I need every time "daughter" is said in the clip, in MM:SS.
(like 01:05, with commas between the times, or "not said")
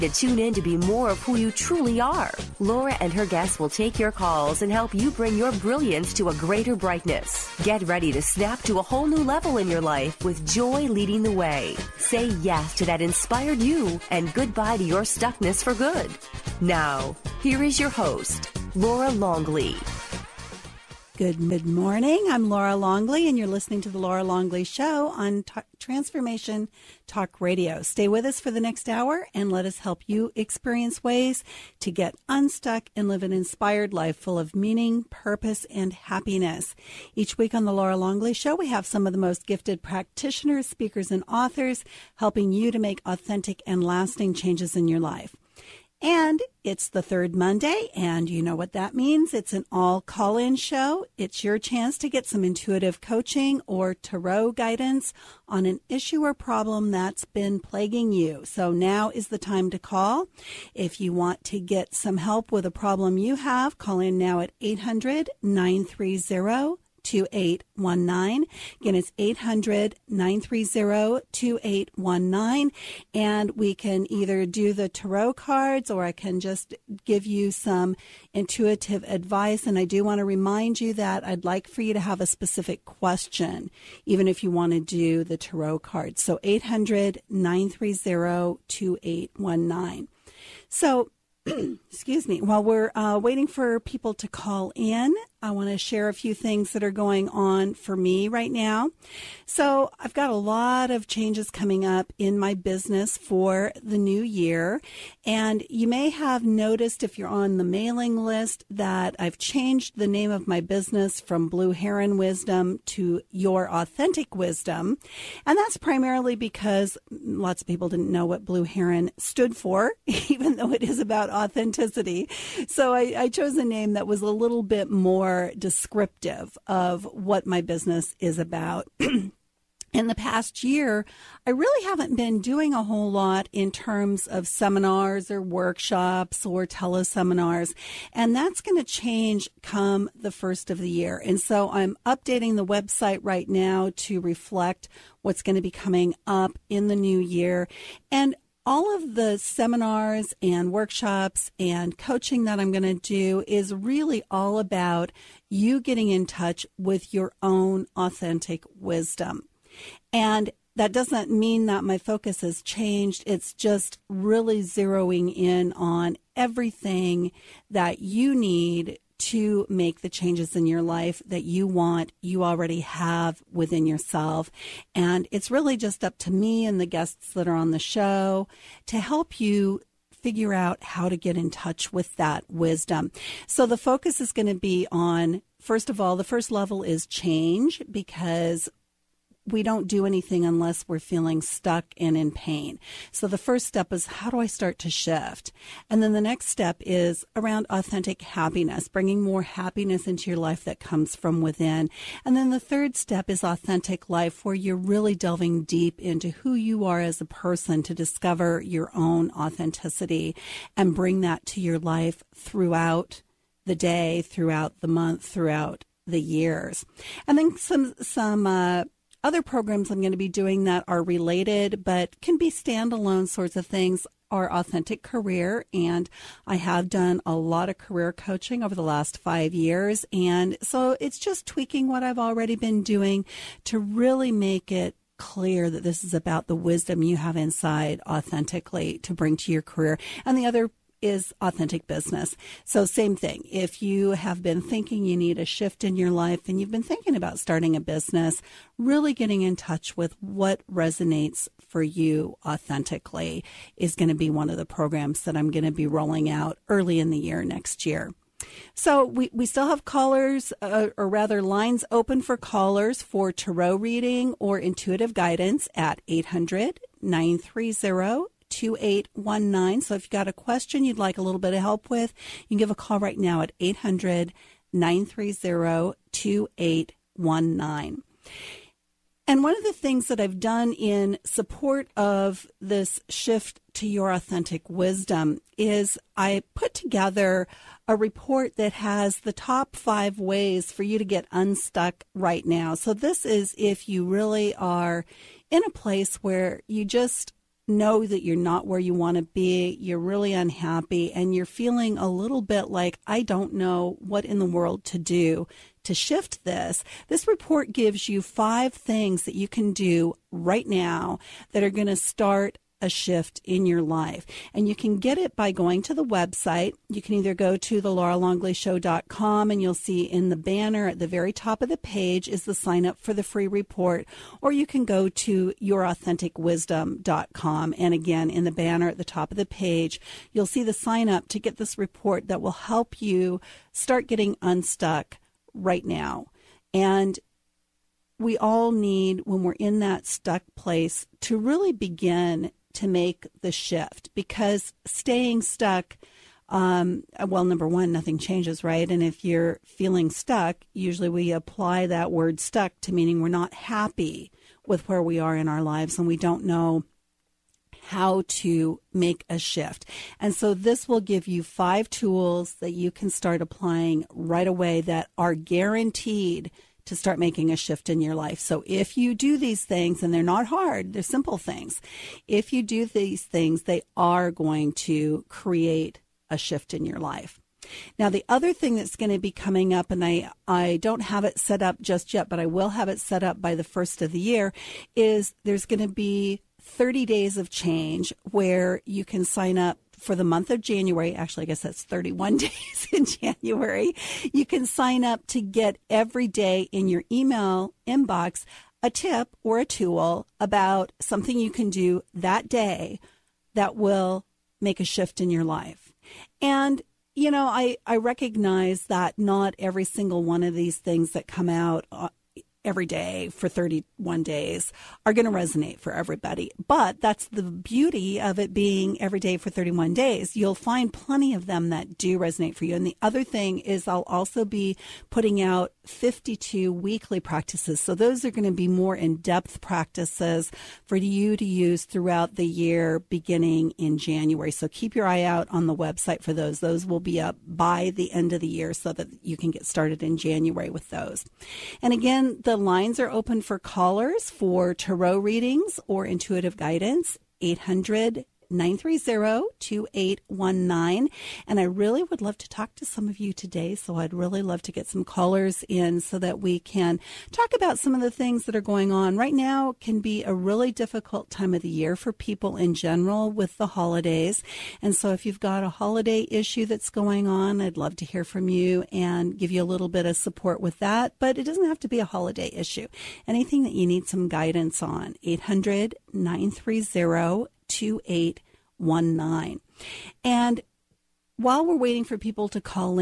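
not said.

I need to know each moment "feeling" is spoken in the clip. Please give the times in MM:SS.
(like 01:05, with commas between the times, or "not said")
03:10, 05:01, 05:49.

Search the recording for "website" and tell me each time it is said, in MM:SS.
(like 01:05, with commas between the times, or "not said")
02:22, 05:16, 07:15.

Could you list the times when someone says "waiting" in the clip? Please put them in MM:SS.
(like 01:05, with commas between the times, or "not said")
01:33, 08:01.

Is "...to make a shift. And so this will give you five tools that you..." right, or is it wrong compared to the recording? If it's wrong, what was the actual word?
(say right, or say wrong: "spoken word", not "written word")
right.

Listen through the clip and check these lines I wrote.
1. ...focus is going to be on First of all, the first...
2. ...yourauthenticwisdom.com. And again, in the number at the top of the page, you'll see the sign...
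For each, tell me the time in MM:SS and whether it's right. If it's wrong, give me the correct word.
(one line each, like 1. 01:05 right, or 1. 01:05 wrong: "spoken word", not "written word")
1. 03:03 right
2. 05:25 wrong: "banner", not "number".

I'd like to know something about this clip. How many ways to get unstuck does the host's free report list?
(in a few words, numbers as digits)
5.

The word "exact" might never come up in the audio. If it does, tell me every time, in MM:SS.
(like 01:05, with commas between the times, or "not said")
not said.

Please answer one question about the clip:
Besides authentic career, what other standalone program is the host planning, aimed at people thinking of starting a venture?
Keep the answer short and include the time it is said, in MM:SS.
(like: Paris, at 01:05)
authentic business, at 04:01.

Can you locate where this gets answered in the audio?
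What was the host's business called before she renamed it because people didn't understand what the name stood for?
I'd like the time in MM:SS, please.
01:51.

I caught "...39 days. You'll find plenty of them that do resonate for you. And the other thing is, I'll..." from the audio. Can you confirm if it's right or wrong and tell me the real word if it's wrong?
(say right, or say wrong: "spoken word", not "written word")
wrong: "31", not "39".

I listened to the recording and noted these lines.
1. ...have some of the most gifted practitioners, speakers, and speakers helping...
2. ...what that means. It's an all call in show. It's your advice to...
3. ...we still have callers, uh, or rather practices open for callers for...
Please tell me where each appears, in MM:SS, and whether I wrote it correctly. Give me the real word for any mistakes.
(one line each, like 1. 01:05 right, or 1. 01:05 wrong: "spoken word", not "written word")
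1. 00:38 wrong: "authors", not "speakers"
2. 00:48 wrong: "chance", not "advice"
3. 04:19 wrong: "lines", not "practices".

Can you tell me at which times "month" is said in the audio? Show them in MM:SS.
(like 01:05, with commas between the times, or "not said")
03:34, 06:30.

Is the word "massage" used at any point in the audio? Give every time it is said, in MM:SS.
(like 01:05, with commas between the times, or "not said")
not said.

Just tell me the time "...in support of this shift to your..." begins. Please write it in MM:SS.
04:40.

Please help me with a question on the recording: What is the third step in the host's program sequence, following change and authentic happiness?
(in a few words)
authentic life.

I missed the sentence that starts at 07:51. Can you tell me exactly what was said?
But it doesn't have to be a holiday issue.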